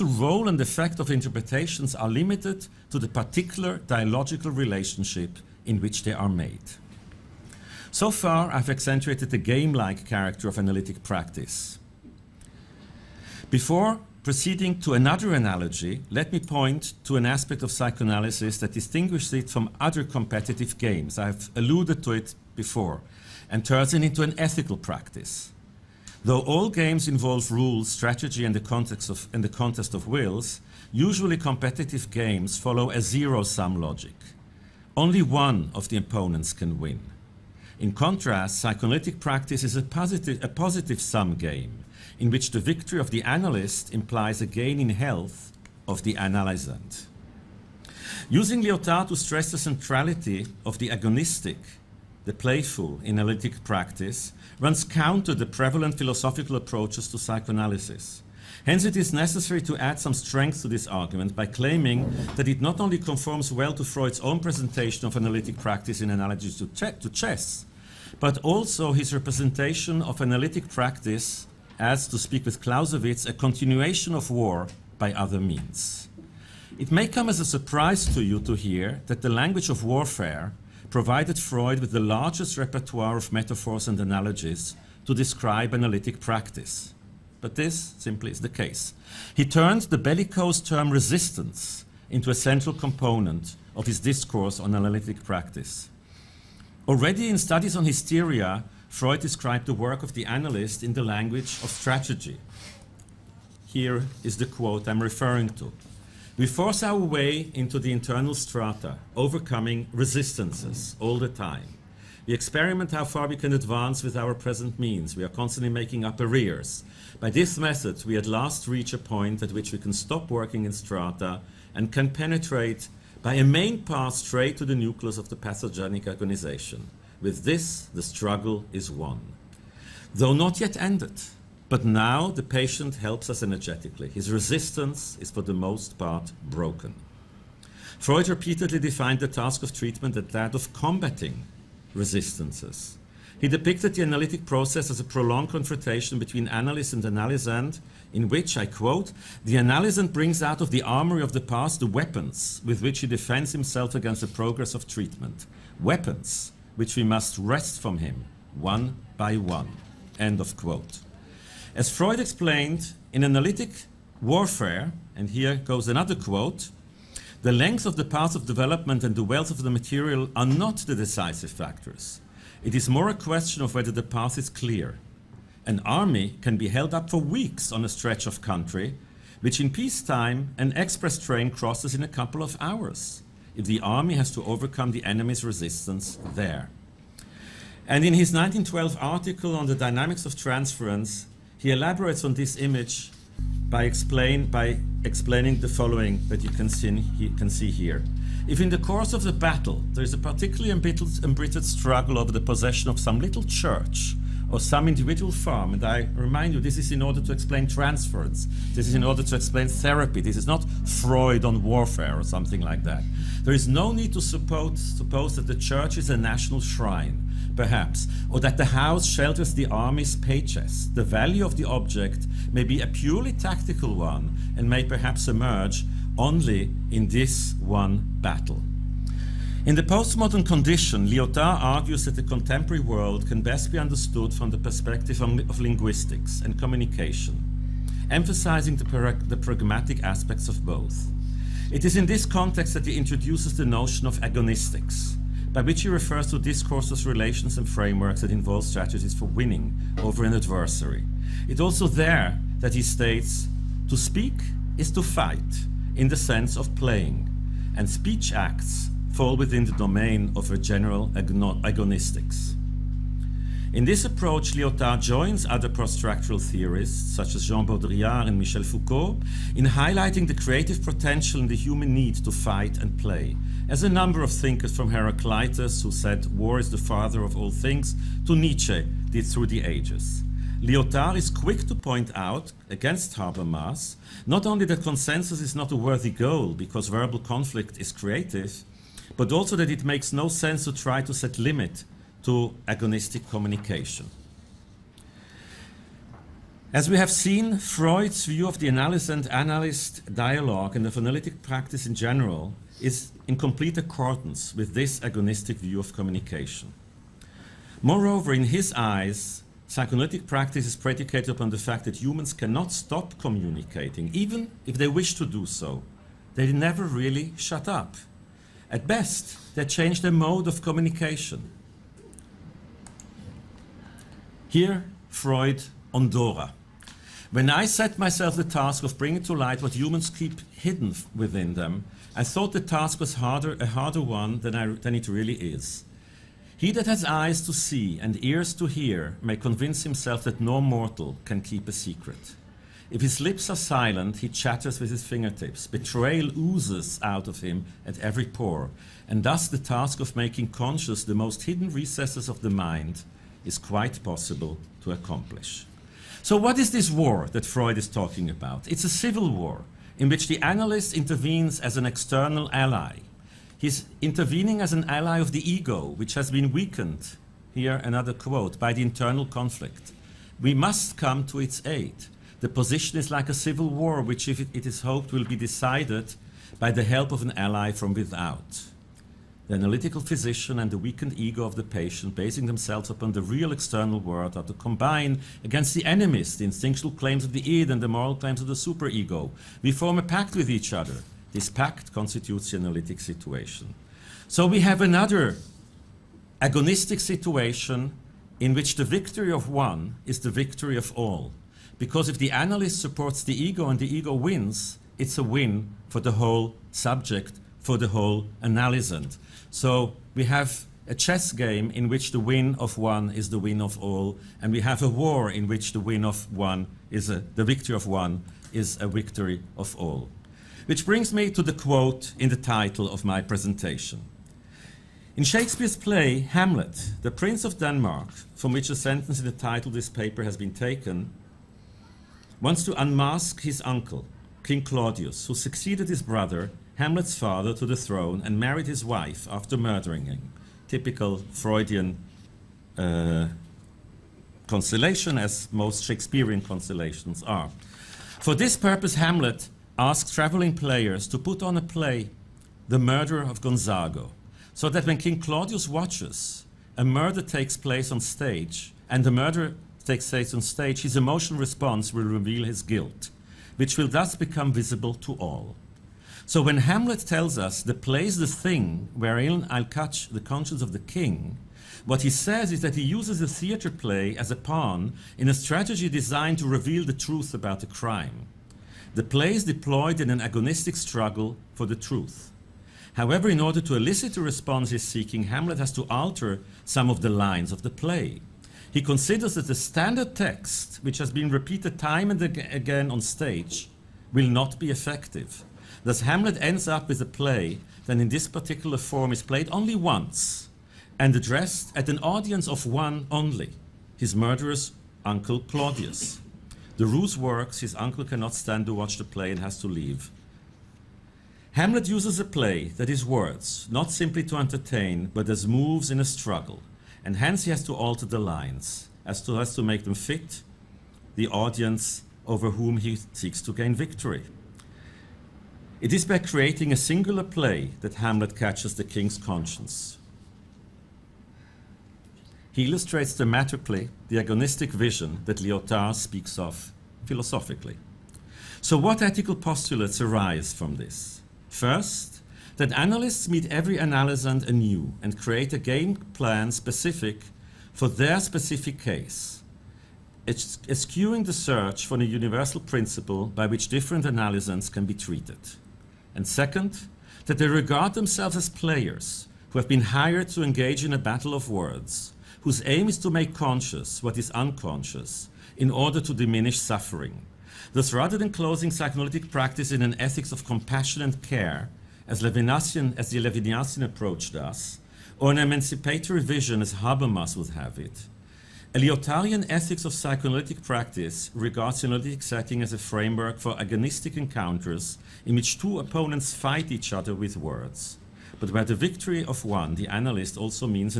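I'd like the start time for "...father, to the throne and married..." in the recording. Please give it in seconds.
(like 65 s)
437 s.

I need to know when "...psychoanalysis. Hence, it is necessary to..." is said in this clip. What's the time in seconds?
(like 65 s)
57 s.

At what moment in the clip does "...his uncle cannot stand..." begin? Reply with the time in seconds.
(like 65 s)
507 s.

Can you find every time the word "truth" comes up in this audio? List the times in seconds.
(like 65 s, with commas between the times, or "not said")
476 s, 481 s.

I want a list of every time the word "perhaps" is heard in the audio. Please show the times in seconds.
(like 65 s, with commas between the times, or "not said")
217 s, 224 s.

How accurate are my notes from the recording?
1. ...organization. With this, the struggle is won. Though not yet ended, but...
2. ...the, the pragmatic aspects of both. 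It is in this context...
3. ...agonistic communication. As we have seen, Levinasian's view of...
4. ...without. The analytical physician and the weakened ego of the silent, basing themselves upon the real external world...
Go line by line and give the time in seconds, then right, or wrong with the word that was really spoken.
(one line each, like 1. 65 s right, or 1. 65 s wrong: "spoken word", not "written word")
1. 126 s right
2. 238 s right
3. 292 s wrong: "Freud", not "Levinasian"
4. 377 s wrong: "patient", not "silent".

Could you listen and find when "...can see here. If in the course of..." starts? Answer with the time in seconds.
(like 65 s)
197 s.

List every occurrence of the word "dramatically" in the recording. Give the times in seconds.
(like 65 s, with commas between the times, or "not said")
533 s.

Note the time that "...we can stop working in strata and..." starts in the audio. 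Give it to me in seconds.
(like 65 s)
119 s.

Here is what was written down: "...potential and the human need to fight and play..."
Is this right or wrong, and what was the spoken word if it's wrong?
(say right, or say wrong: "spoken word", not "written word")
right.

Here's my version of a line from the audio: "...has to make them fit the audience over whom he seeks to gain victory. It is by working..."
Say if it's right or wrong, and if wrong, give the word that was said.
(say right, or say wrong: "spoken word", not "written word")
wrong: "creating", not "working".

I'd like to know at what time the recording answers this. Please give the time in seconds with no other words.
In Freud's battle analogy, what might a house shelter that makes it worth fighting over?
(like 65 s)
219 s.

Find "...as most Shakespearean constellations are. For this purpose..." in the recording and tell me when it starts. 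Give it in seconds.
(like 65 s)
444 s.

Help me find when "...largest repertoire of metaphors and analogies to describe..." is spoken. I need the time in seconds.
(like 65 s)
81 s.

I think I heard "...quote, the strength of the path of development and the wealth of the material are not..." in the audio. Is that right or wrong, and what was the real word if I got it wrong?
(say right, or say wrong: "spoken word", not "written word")
wrong: "length", not "strength".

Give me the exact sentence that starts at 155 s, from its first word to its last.
Weapons which we must wrest from him, one by one.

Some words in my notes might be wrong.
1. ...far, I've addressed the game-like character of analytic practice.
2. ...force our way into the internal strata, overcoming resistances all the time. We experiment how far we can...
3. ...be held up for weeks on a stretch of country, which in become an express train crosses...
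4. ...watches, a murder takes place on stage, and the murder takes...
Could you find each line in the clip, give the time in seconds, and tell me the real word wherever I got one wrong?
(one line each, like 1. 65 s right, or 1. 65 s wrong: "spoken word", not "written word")
1. 8 s wrong: "accentuated", not "addressed"
2. 106 s right
3. 176 s wrong: "peacetime", not "become"
4. 455 s right.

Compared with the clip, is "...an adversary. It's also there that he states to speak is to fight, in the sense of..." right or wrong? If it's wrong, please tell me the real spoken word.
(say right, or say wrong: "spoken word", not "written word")
right.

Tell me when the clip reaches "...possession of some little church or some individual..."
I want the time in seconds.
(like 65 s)
202 s.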